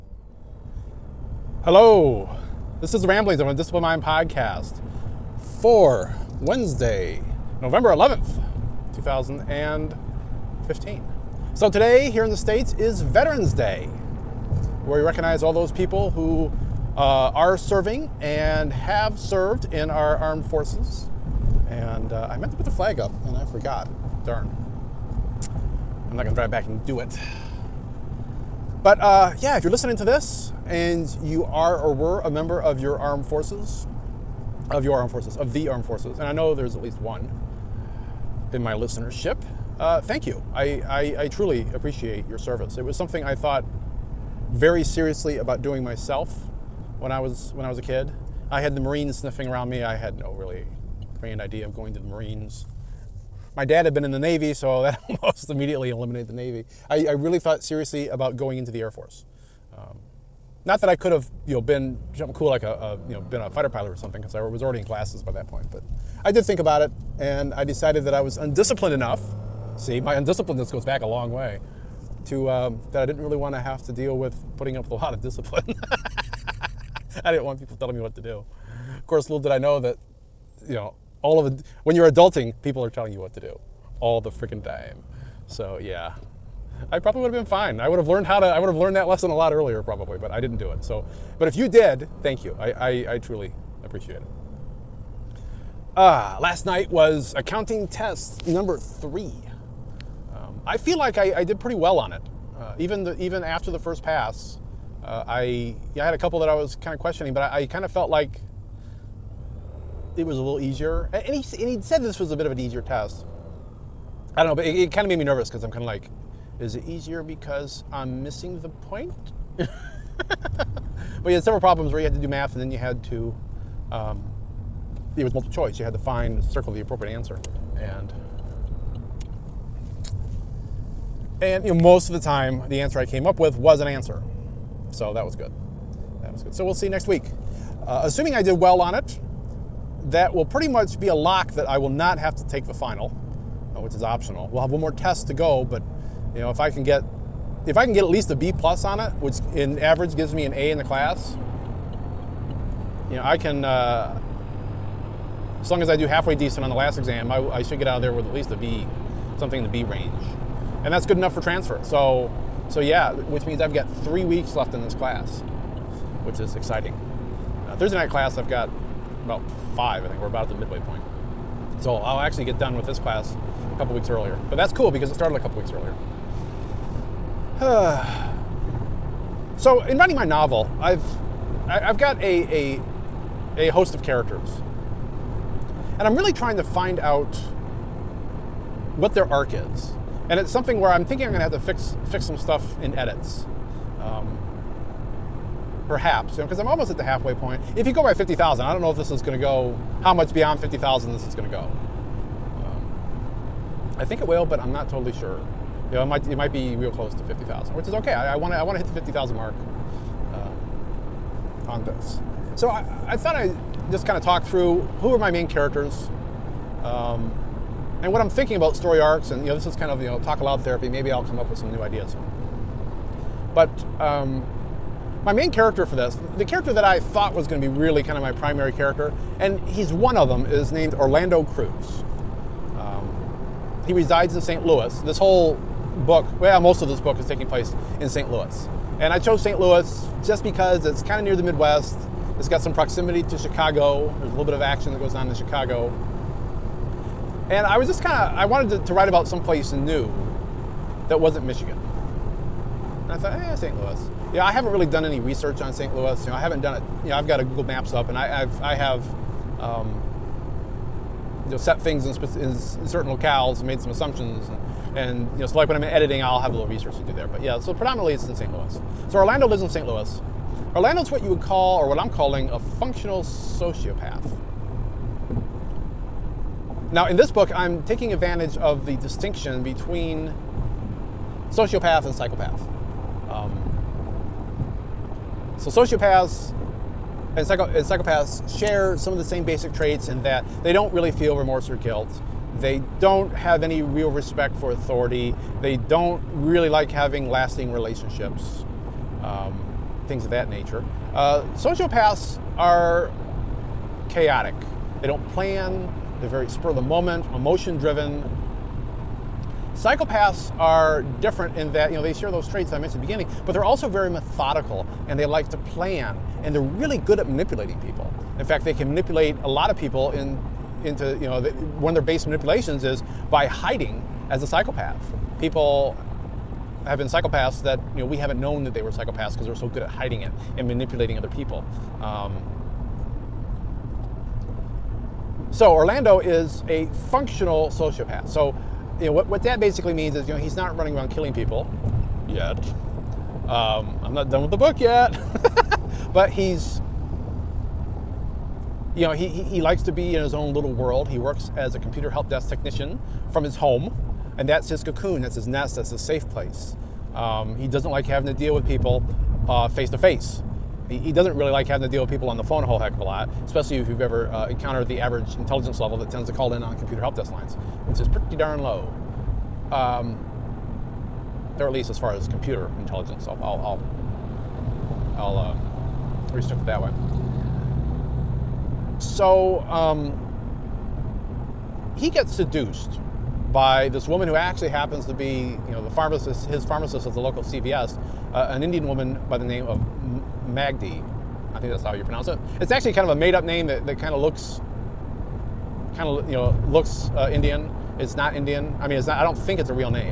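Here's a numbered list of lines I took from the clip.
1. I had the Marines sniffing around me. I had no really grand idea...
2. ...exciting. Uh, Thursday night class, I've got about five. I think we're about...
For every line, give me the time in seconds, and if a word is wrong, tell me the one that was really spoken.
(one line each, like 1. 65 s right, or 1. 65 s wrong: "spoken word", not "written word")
1. 48 s right
2. 166 s right.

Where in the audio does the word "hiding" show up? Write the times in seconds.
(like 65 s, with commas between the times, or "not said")
323 s, 329 s.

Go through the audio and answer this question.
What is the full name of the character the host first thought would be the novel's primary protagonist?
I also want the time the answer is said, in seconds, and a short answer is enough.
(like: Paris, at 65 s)
Orlando Cruz, at 230 s.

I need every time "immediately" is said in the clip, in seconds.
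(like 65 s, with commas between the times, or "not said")
55 s.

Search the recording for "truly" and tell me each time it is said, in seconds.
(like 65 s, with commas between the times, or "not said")
41 s, 93 s.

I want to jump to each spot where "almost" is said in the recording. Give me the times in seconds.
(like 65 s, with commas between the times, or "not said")
55 s, 196 s.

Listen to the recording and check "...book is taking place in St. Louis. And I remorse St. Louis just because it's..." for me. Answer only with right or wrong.
wrong.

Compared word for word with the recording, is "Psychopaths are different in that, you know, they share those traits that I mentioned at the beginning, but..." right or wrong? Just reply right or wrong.
right.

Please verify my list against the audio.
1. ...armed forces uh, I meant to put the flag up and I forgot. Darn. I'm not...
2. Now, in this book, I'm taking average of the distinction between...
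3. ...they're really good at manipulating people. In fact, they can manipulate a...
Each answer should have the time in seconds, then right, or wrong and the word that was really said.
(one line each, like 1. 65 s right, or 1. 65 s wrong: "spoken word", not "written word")
1. 20 s right
2. 276 s wrong: "advantage", not "average"
3. 316 s right.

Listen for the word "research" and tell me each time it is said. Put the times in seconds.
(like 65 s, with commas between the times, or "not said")
255 s, 266 s.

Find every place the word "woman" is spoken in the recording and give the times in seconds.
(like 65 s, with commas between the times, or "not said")
384 s, 388 s.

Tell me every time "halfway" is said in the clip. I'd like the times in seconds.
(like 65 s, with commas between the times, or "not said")
156 s, 197 s.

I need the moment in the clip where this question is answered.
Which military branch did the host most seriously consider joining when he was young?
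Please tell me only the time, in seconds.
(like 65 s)
58 s.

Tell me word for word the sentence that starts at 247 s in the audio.
And I was just kind of, I wanted to, to, write about someplace new that wasn't Michigan.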